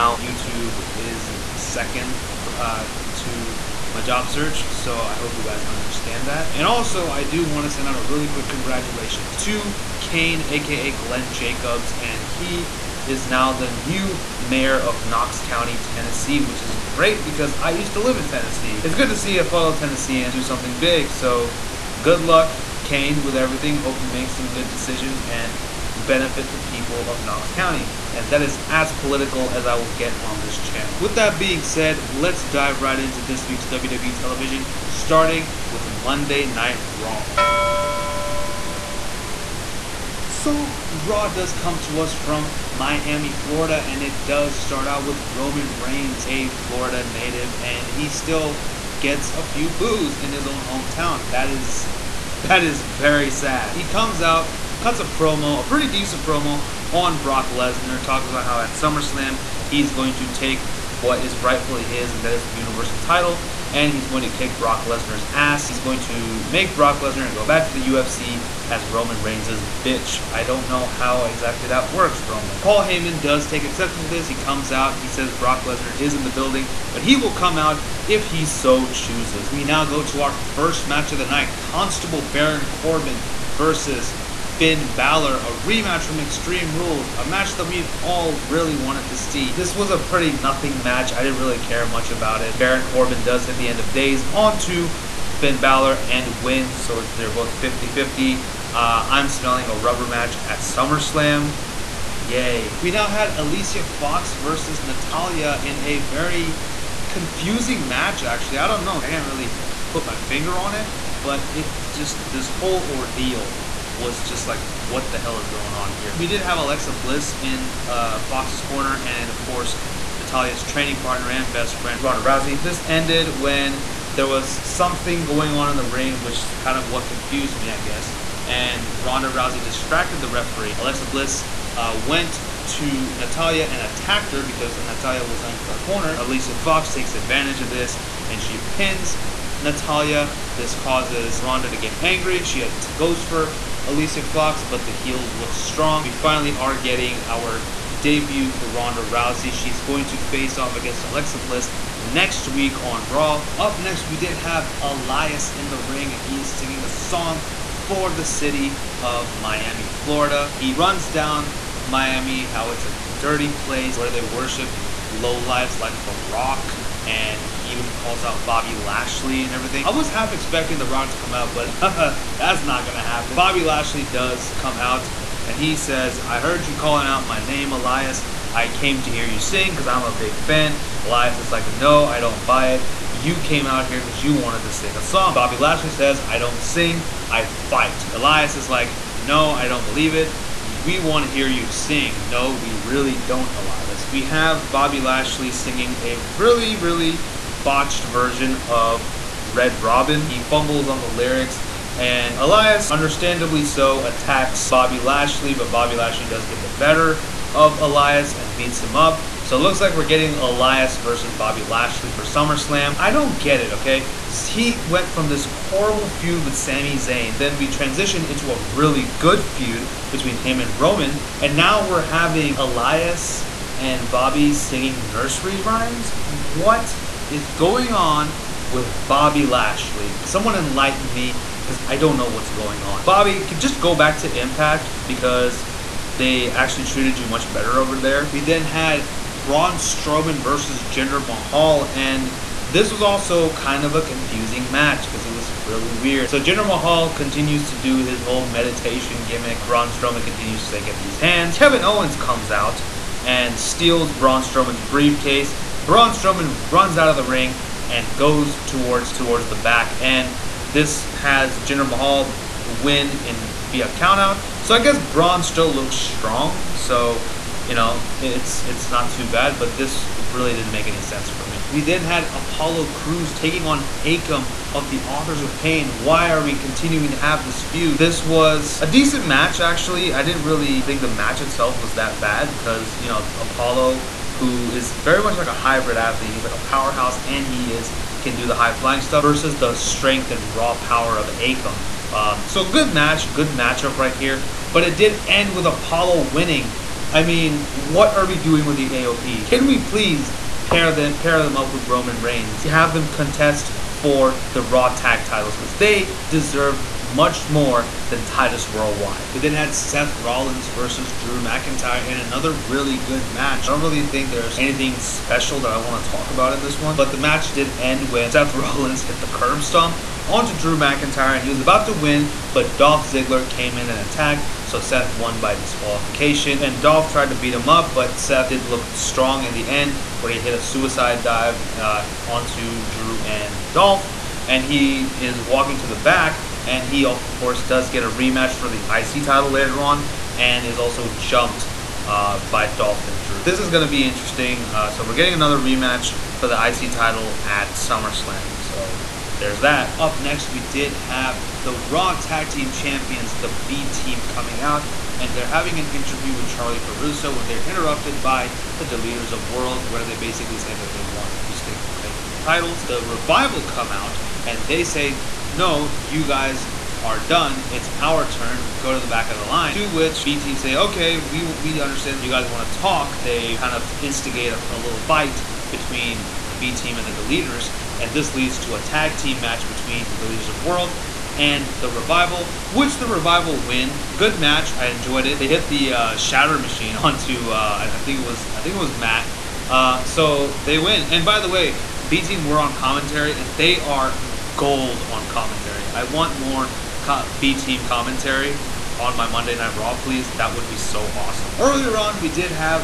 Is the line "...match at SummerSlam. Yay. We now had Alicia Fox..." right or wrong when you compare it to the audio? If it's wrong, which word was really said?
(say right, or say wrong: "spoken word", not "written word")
right.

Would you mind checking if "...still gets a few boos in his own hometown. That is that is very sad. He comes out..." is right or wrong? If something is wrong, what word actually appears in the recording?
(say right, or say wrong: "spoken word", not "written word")
right.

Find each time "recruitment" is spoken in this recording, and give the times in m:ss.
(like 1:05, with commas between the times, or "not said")
not said.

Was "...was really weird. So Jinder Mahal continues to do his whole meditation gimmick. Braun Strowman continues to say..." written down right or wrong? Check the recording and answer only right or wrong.
right.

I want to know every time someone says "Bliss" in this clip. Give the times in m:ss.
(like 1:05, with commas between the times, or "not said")
1:56, 2:11, 2:31.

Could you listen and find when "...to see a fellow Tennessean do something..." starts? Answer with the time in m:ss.
0:19.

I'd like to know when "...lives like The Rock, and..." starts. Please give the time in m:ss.
2:45.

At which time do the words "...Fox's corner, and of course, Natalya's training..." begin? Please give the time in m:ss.
1:58.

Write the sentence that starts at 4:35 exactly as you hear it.
Why are we continuing to have this feud?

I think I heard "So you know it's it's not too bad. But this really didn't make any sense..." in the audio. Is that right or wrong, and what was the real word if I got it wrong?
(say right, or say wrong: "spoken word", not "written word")
right.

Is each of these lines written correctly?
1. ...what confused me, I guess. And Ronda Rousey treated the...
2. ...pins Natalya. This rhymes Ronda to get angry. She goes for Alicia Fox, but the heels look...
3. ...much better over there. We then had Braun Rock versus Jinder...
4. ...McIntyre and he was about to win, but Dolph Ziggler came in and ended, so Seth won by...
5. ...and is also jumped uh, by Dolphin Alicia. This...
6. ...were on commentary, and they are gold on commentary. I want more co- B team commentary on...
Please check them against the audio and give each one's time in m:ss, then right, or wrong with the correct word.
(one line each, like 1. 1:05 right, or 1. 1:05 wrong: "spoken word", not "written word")
1. 2:06 wrong: "distracted", not "treated"
2. 2:18 wrong: "causes", not "rhymes"
3. 3:57 wrong: "Strowman", not "Rock"
4. 5:20 wrong: "attacked", not "ended"
5. 5:40 wrong: "Drew", not "Alicia"
6. 6:32 right.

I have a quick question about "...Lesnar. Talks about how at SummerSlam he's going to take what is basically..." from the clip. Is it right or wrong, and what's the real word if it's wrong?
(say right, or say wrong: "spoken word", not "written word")
wrong: "rightfully", not "basically".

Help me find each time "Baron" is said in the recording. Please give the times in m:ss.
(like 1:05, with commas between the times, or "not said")
1:22, 1:32.